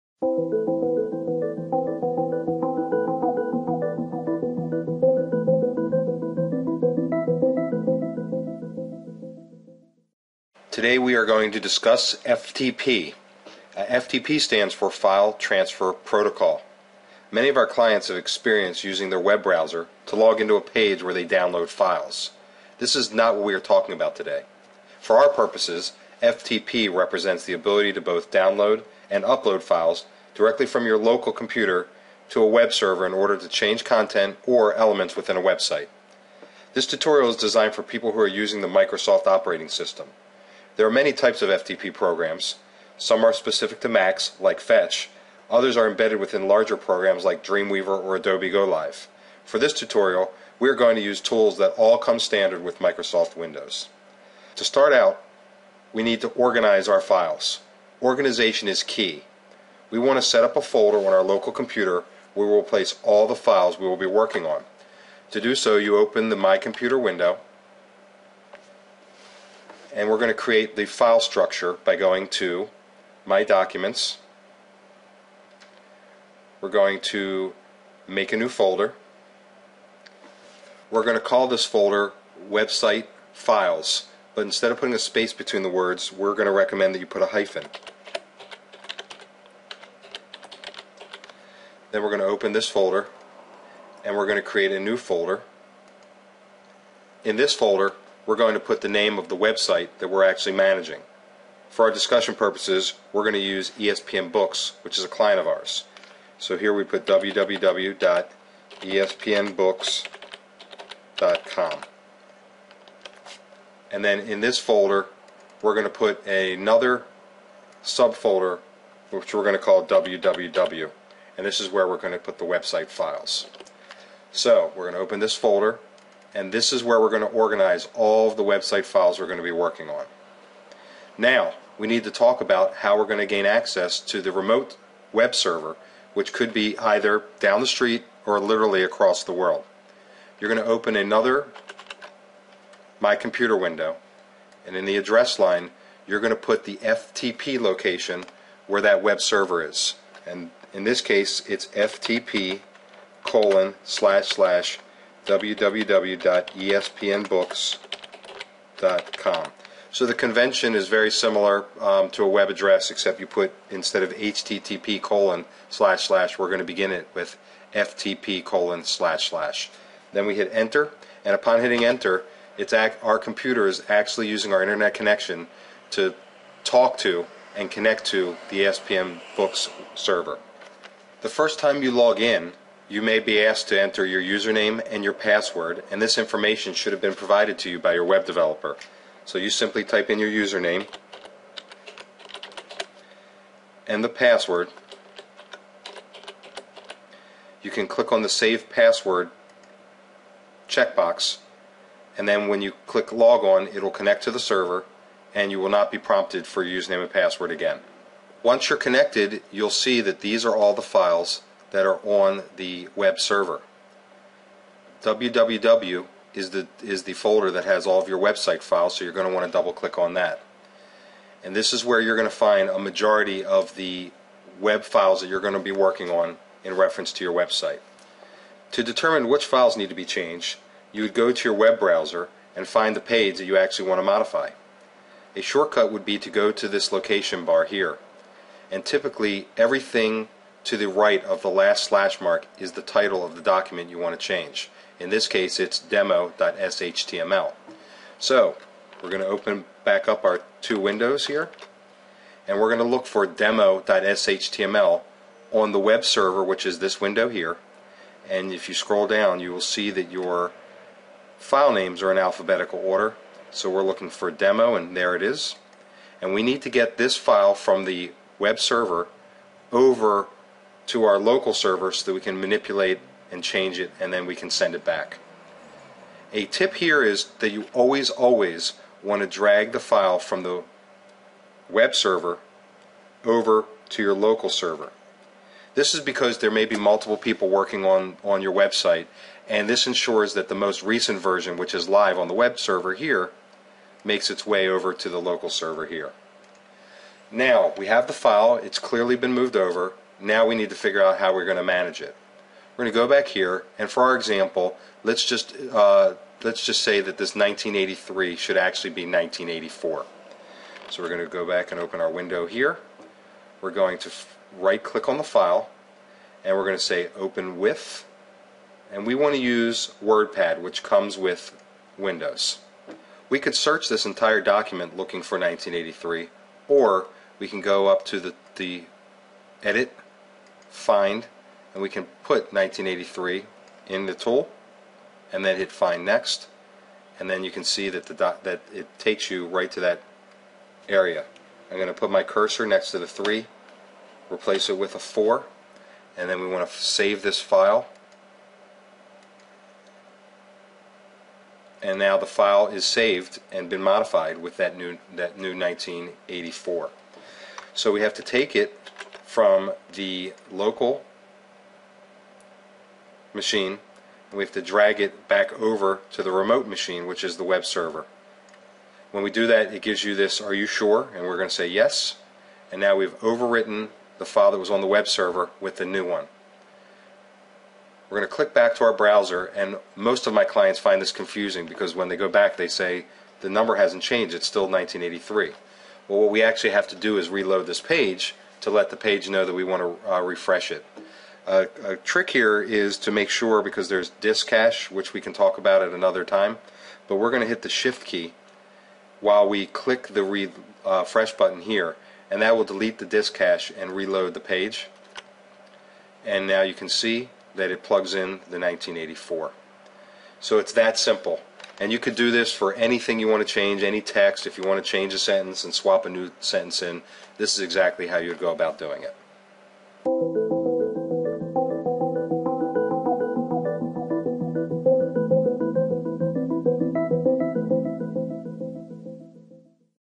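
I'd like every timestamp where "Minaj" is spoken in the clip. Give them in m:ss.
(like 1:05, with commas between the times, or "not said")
not said.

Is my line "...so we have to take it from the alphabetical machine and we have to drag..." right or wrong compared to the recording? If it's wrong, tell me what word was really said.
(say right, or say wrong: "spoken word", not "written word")
wrong: "local", not "alphabetical".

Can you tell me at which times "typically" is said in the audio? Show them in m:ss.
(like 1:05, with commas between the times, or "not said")
3:58.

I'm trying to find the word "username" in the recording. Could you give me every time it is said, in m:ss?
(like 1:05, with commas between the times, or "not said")
3:04, 3:10, 3:26.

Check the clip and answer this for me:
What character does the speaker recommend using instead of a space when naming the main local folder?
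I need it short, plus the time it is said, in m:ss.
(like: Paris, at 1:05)
A hyphen, at 1:27.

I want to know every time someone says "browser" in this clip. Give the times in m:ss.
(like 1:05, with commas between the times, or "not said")
0:19, 3:51, 6:18.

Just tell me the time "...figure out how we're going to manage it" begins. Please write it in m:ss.
5:00.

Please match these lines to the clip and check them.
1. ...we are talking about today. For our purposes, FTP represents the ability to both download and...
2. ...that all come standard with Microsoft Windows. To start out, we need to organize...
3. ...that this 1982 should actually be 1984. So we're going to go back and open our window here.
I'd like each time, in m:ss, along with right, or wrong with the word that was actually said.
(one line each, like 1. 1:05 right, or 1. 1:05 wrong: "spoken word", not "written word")
1. 0:23 right
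2. 0:51 right
3. 5:06 wrong: "1983", not "1982".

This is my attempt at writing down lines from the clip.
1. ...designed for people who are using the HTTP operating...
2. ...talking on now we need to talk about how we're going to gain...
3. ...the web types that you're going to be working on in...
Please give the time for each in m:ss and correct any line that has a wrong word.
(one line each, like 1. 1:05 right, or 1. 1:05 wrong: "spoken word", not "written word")
1. 0:37 wrong: "Microsoft", not "HTTP"
2. 2:09 wrong: "working", not "talking"
3. 3:43 wrong: "files", not "types".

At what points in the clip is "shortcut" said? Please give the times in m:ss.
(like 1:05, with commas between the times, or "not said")
3:55.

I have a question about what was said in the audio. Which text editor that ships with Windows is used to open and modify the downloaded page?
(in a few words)
WordPad.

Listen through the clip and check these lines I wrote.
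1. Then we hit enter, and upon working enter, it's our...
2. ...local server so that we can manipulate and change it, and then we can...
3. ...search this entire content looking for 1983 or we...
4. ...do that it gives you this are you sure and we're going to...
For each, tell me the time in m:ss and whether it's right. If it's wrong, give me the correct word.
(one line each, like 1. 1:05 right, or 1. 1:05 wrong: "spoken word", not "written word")
1. 2:50 wrong: "hitting", not "working"
2. 4:31 right
3. 5:23 wrong: "document", not "content"
4. 6:09 right.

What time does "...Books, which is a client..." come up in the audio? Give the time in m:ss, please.
1:44.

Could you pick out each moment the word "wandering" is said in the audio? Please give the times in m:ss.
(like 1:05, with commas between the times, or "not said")
not said.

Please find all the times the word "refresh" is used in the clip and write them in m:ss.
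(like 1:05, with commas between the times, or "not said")
6:30, 6:40.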